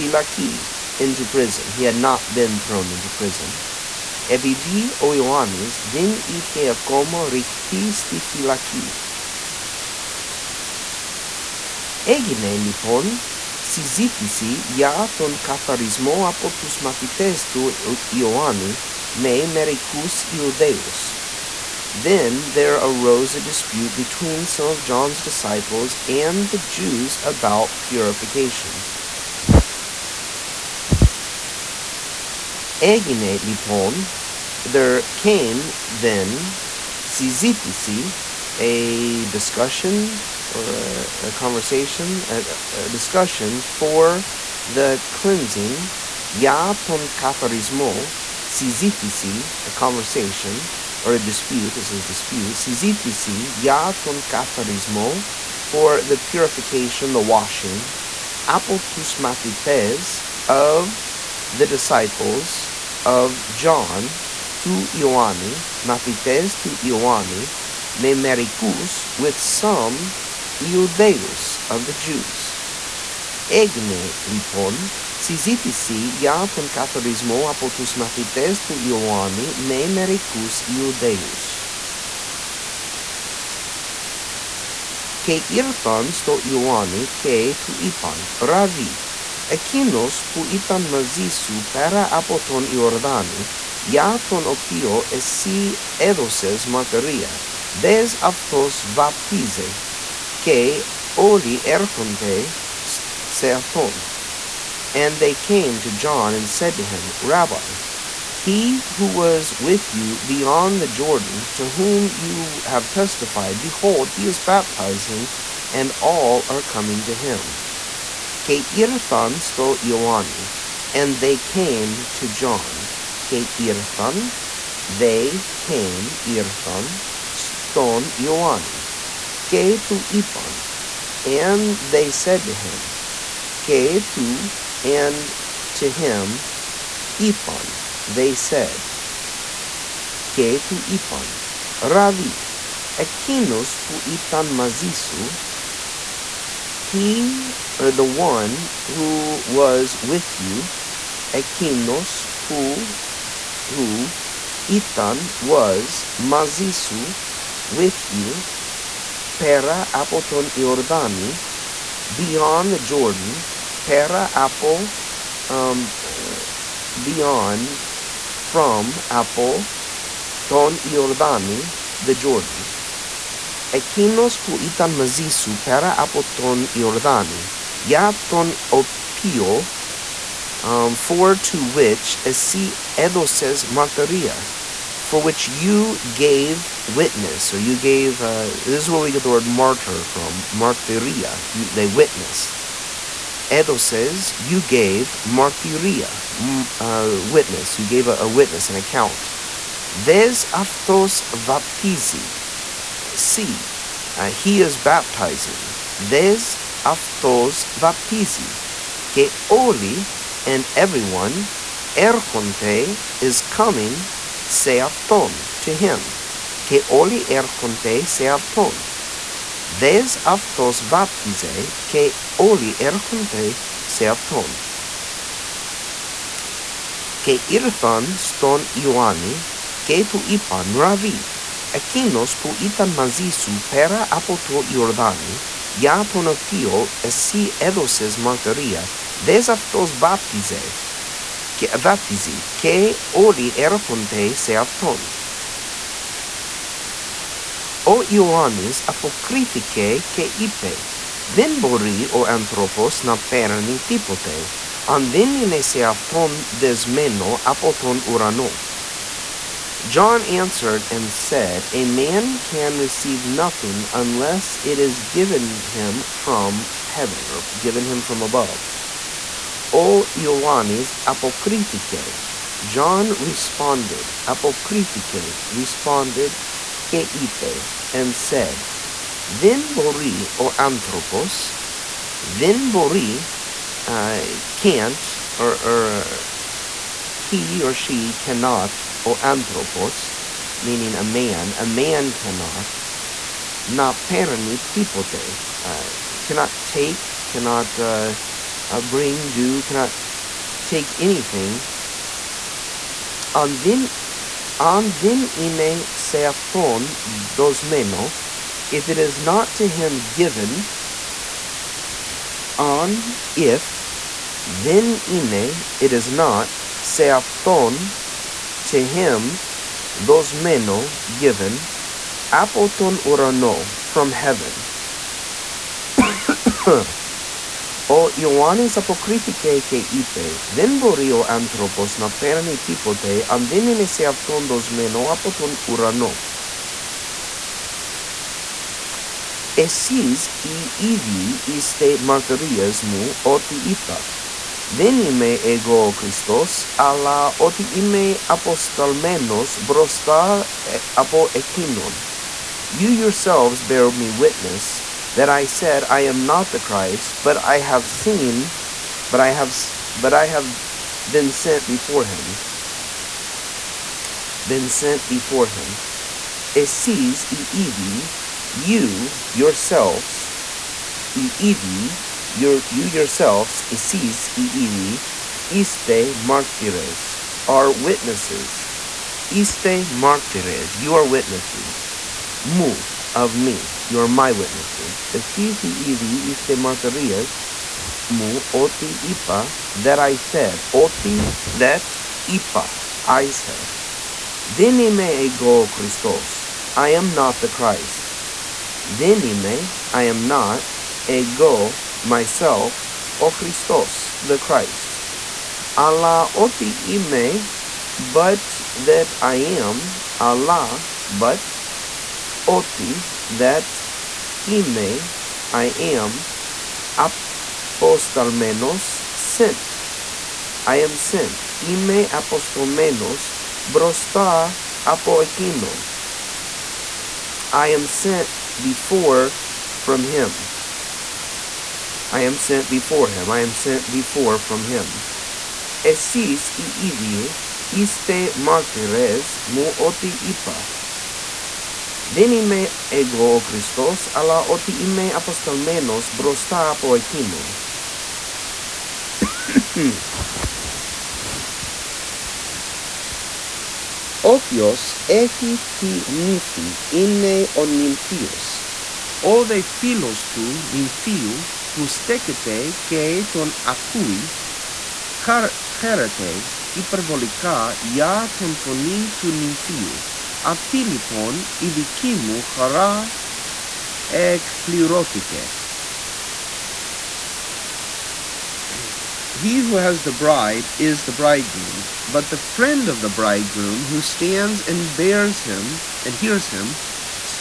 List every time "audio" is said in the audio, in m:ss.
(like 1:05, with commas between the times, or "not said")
not said.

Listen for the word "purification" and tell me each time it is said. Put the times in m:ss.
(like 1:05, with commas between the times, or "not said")
0:27, 0:56.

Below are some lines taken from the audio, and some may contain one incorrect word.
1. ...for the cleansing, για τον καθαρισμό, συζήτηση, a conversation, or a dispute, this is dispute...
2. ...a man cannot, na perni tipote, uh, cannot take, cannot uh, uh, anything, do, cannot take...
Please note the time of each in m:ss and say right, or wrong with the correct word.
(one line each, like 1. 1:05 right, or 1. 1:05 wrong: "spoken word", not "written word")
1. 0:43 right
2. 4:51 wrong: "bring", not "anything".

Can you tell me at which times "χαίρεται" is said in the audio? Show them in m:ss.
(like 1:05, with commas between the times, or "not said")
7:45.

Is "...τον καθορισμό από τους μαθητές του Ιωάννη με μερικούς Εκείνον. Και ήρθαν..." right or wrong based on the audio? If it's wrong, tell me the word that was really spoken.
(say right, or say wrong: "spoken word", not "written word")
wrong: "Ιουδαίους", not "Εκείνον".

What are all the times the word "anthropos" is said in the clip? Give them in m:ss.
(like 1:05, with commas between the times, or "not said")
4:40, 4:49.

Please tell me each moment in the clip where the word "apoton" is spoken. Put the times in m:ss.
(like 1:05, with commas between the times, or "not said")
2:39.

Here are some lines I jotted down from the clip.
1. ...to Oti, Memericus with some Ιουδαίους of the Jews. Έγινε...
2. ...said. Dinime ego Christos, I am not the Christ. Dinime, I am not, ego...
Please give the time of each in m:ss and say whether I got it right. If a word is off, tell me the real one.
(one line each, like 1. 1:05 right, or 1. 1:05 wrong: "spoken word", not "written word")
1. 1:06 wrong: "Ioanni", not "Oti"
2. 6:33 right.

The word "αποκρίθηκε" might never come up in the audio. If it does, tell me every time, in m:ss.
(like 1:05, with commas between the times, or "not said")
4:08, 5:28.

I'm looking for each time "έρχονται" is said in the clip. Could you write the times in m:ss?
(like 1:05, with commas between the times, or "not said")
1:41, 4:03.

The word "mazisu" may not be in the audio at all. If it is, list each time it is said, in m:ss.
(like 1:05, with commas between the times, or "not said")
2:24, 2:36.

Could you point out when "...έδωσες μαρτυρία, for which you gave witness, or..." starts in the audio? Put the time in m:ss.
3:02.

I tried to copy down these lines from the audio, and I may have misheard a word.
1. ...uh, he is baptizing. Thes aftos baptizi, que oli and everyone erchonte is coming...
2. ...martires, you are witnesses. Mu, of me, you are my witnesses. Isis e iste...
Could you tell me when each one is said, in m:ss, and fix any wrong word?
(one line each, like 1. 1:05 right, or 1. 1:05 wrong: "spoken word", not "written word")
1. 3:24 right
2. 6:19 right.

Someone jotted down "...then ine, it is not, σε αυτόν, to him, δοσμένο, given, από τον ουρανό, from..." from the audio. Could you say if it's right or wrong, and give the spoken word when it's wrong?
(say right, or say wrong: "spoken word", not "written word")
right.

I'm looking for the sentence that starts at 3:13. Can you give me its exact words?
Έδωσες, you gave martyria, mm, uh, witness, you gave a, a witness, an account.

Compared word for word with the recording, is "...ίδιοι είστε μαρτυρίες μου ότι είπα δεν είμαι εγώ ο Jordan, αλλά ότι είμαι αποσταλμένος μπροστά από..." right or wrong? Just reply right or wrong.
wrong.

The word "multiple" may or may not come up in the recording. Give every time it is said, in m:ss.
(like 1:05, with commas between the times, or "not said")
not said.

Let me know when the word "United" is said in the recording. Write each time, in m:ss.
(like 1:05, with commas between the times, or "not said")
not said.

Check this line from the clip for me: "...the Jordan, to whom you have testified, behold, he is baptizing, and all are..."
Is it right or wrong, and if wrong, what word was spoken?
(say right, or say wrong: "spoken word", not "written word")
right.